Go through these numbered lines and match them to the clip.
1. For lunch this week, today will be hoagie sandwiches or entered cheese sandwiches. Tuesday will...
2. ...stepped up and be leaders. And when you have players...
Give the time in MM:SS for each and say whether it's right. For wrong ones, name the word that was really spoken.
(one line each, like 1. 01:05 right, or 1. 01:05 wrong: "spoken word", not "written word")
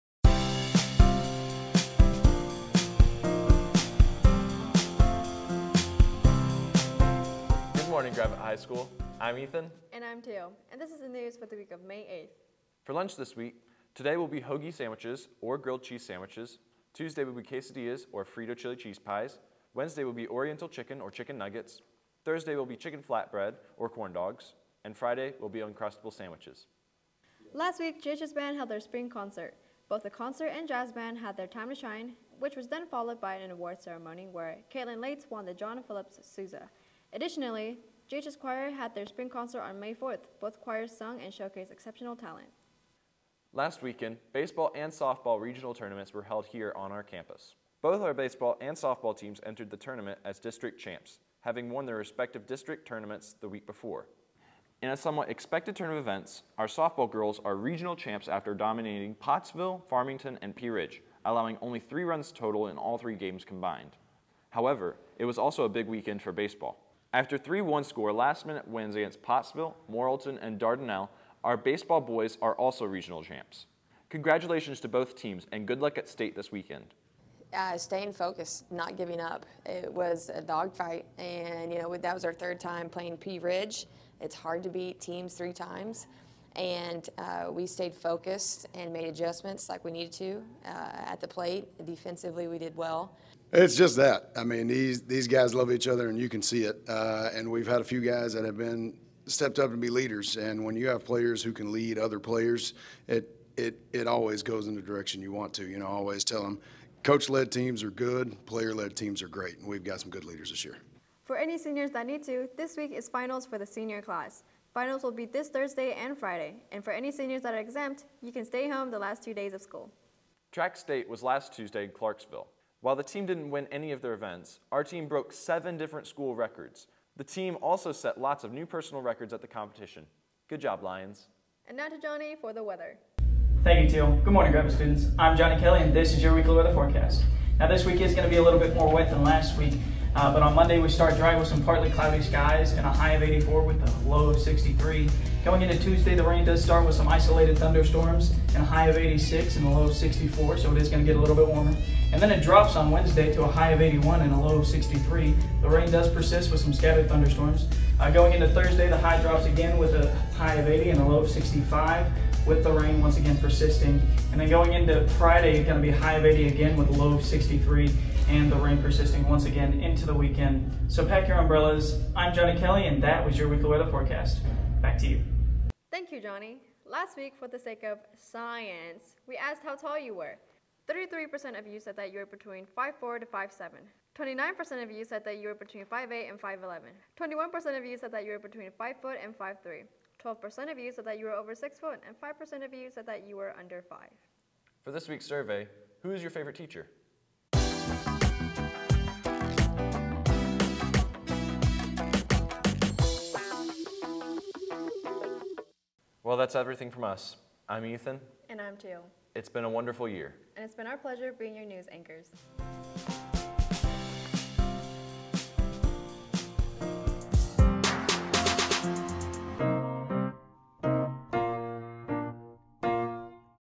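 1. 00:12 wrong: "grilled", not "entered"
2. 01:39 right.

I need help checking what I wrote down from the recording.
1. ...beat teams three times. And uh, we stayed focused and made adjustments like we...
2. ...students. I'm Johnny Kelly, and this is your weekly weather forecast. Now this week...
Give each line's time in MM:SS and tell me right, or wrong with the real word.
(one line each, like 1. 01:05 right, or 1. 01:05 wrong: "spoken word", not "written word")
1. 01:24 right
2. 02:14 right.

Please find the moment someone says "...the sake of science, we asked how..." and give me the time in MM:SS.
02:57.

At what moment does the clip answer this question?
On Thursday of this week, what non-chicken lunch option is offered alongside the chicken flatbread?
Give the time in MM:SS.
00:23.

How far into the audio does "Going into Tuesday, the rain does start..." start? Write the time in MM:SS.
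02:25.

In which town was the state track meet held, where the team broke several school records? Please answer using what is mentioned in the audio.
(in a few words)
Clarksville.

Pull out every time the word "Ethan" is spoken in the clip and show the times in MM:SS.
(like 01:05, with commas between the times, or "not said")
00:09, 03:27.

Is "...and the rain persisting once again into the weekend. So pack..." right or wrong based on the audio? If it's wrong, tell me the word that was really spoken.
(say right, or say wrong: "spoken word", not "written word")
right.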